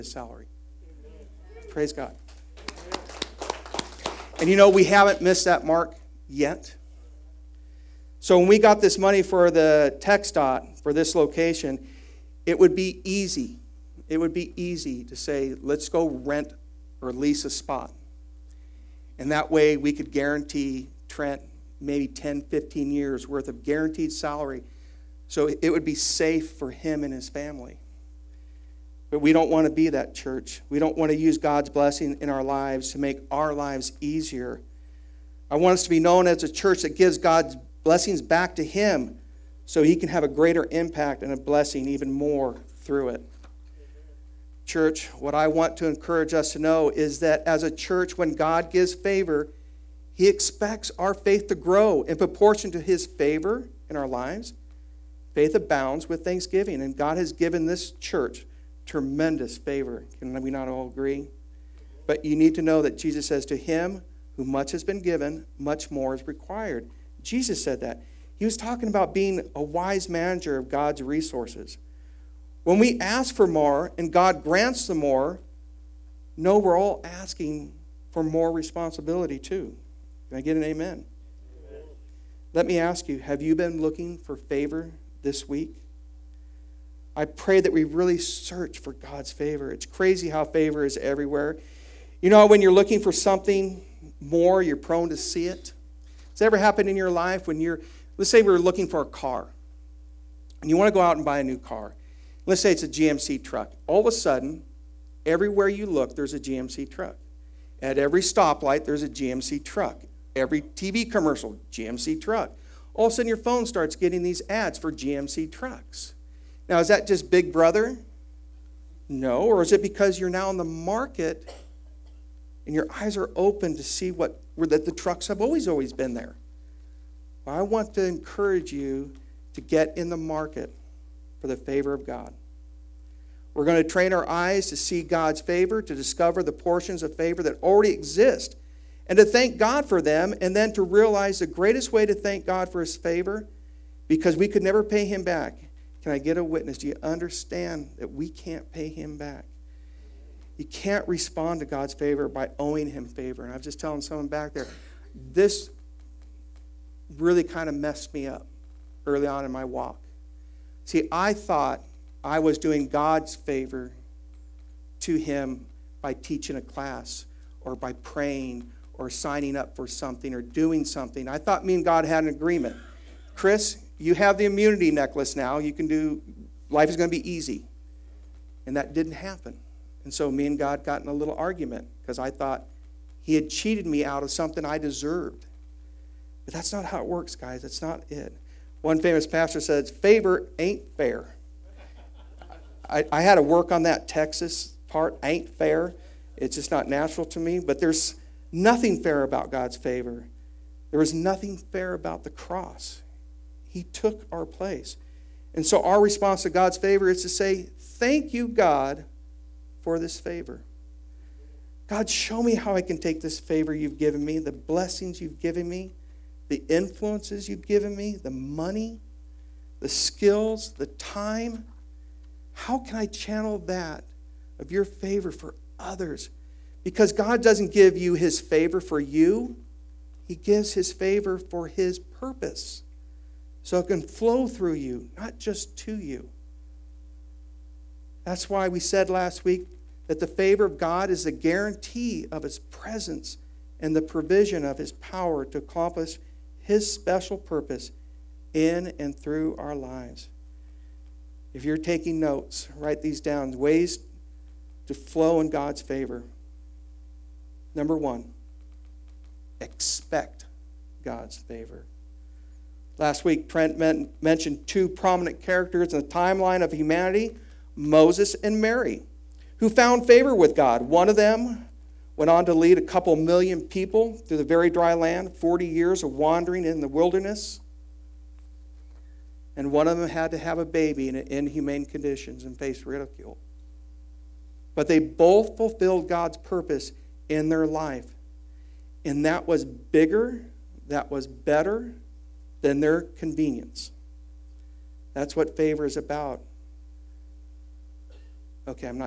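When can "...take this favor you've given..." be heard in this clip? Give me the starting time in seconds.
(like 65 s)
212 s.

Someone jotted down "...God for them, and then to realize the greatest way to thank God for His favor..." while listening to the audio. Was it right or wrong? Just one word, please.
right.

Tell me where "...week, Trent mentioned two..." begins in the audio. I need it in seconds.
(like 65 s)
263 s.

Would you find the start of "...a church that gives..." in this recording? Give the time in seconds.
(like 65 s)
36 s.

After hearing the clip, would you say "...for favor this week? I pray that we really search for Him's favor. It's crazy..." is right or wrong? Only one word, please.
wrong.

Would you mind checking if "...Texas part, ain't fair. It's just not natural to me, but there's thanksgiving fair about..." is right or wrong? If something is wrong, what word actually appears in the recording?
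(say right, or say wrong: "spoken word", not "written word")
wrong: "nothing", not "thanksgiving".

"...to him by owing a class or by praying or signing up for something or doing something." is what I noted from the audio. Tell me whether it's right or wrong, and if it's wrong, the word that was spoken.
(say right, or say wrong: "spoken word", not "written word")
wrong: "teaching", not "owing".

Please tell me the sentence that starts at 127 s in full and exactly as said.
Well, I want to encourage you to get in the market for the favor of God.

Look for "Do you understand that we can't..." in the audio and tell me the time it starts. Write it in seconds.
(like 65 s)
146 s.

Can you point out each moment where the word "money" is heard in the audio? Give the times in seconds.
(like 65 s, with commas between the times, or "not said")
8 s, 218 s.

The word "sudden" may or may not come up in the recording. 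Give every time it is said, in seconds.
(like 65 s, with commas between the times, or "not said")
104 s, 113 s.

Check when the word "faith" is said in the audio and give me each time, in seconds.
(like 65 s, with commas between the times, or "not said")
51 s, 55 s.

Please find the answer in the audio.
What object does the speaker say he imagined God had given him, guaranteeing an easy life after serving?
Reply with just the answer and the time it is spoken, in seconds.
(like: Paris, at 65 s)
immunity necklace, at 174 s.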